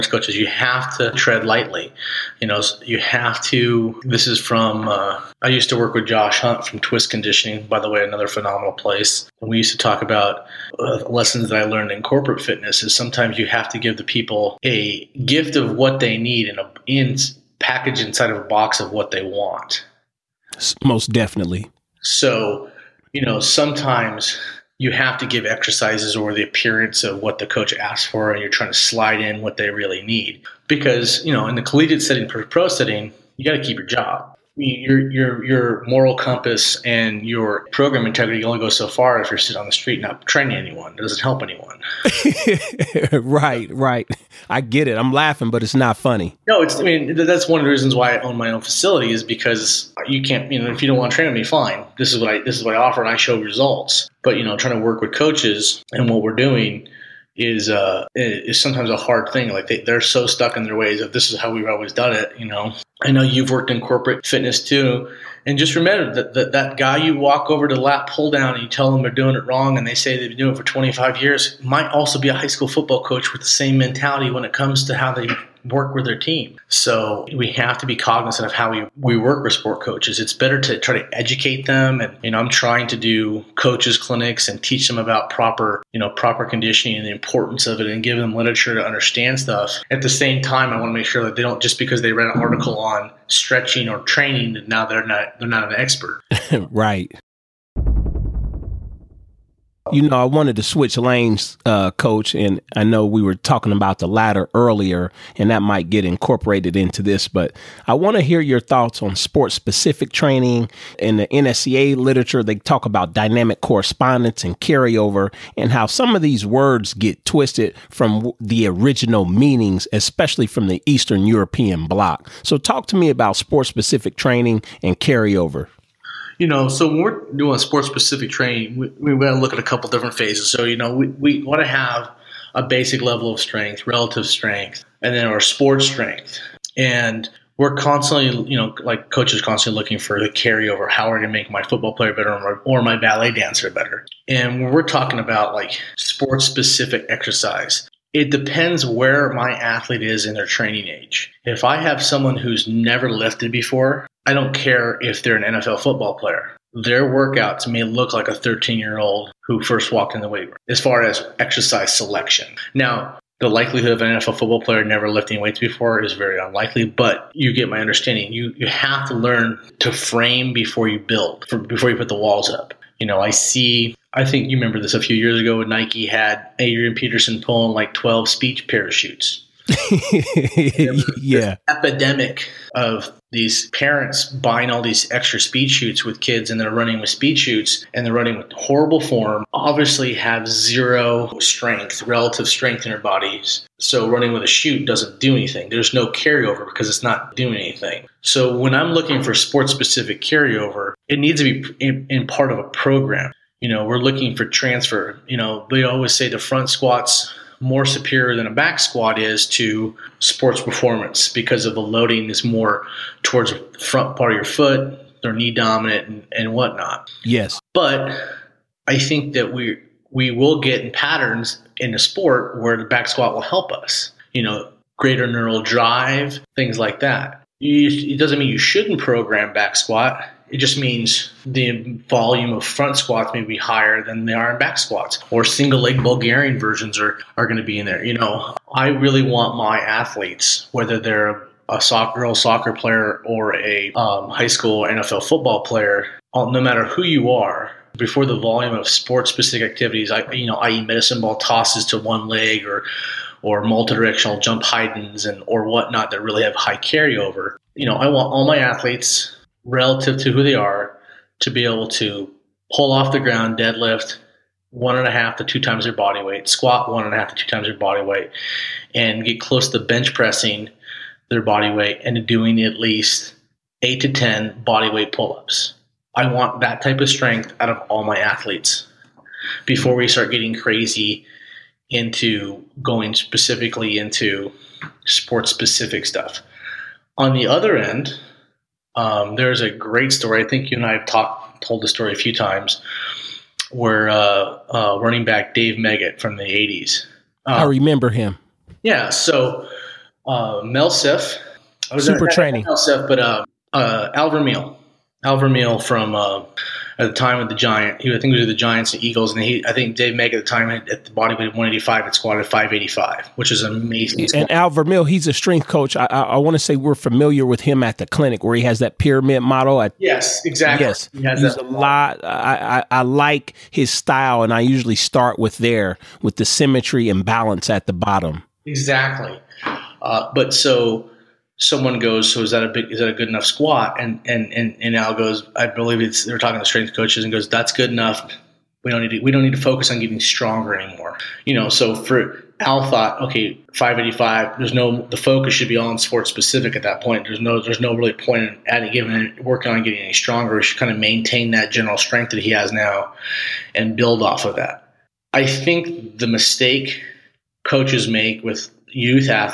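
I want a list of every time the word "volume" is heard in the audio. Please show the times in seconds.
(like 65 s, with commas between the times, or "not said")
232 s, 248 s.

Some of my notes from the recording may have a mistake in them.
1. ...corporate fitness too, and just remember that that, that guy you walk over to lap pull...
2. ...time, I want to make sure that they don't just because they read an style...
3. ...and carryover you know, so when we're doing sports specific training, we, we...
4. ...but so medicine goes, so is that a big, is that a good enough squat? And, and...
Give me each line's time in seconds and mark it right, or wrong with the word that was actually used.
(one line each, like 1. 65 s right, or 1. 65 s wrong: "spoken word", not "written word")
1. 63 s right
2. 90 s wrong: "article", not "style"
3. 124 s right
4. 330 s wrong: "someone", not "medicine".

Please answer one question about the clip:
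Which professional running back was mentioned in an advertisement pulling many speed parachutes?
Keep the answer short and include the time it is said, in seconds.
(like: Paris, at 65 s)
Adrian Peterson, at 176 s.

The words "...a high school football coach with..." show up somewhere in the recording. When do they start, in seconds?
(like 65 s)
72 s.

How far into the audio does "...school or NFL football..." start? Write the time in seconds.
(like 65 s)
244 s.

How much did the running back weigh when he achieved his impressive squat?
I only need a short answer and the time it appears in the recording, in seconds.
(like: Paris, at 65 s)
185, at 311 s.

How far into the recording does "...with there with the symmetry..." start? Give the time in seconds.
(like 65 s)
325 s.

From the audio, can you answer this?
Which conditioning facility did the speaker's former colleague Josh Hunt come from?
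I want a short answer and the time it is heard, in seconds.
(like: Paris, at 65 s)
Twist Conditioning, at 6 s.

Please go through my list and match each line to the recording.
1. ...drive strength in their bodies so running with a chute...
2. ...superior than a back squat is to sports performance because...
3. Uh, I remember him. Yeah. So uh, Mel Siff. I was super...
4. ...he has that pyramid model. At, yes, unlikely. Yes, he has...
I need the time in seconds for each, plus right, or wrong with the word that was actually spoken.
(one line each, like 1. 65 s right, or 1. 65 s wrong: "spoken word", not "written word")
1. 192 s wrong: "relative", not "drive"
2. 207 s right
3. 297 s right
4. 318 s wrong: "exactly", not "unlikely".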